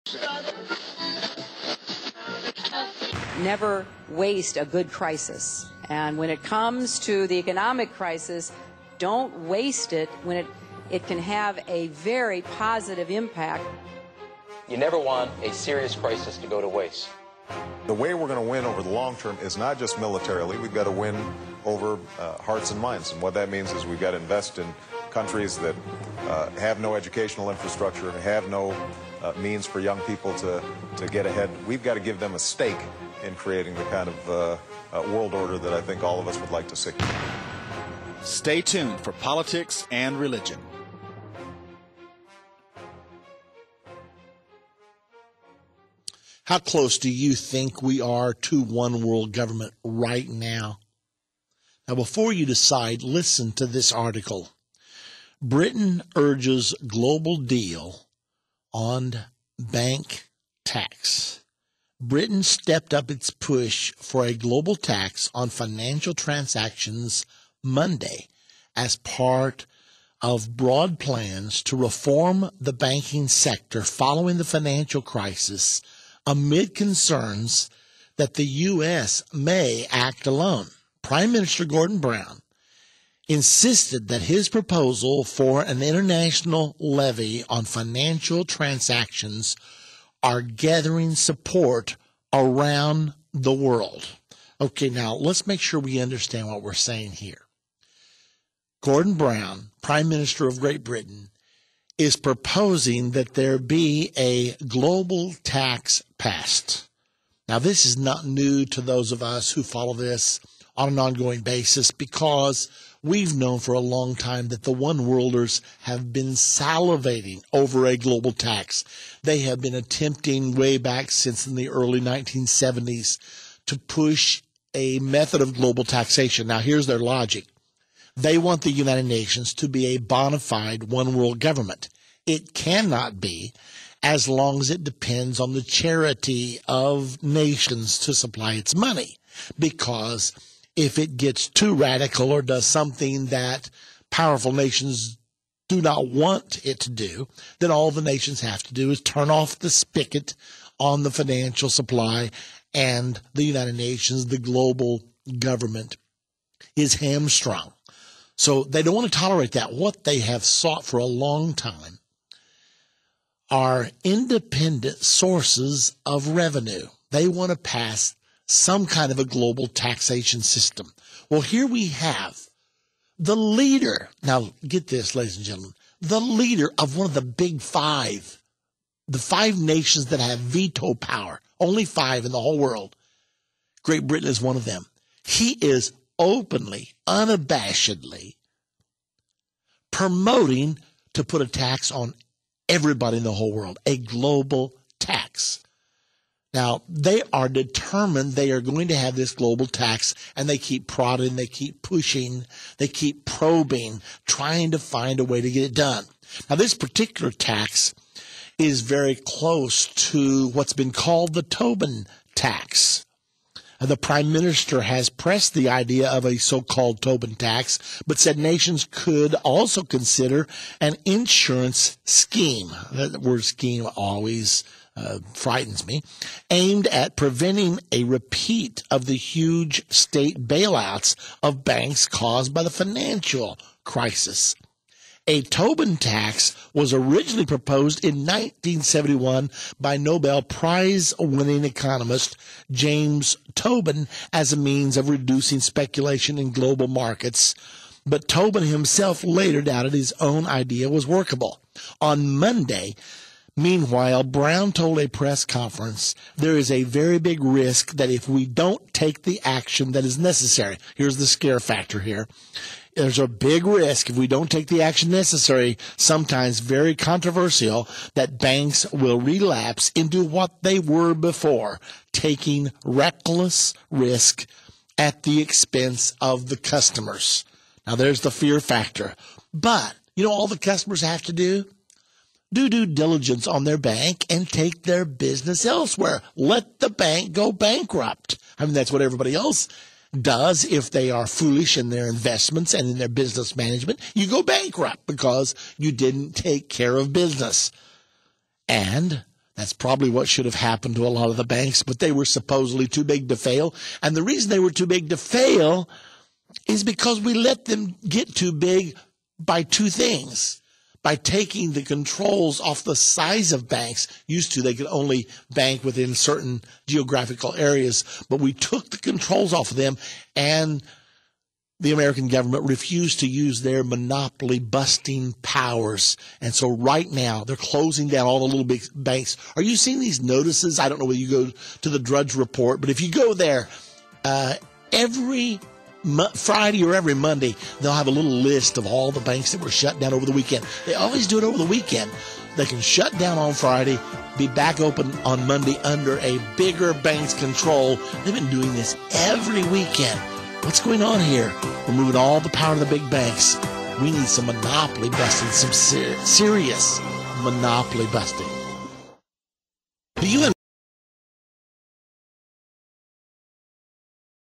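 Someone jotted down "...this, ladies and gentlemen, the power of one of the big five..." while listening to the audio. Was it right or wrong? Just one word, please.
wrong.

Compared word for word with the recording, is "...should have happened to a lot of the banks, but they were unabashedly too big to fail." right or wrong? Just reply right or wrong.
wrong.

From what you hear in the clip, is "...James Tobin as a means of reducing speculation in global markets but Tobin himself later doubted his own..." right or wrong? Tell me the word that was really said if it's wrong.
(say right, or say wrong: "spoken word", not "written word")
right.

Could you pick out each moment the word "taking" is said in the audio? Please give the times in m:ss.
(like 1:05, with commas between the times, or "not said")
4:32, 5:11.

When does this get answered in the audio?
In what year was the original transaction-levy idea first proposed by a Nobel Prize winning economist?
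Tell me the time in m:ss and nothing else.
3:58.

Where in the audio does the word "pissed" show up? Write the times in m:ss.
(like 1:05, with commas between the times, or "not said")
not said.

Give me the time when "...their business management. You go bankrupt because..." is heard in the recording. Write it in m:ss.
4:52.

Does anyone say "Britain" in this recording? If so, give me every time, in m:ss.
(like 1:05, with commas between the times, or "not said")
0:55, 1:01, 1:40, 3:04.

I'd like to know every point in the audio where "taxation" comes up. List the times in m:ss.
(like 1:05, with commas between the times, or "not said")
2:05, 2:49.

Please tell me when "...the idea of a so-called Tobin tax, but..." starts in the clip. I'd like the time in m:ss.
3:35.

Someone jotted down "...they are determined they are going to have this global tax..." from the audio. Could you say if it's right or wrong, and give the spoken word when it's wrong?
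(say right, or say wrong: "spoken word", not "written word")
right.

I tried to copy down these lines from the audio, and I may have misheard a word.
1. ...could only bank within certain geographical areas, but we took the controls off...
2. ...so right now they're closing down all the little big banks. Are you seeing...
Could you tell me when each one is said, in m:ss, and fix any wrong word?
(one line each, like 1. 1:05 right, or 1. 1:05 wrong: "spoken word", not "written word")
1. 5:14 right
2. 5:26 right.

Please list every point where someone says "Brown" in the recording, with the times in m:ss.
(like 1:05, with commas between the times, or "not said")
1:21, 1:39, 4:14.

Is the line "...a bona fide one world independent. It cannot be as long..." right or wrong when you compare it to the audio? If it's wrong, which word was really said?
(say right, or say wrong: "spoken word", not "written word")
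wrong: "government", not "independent".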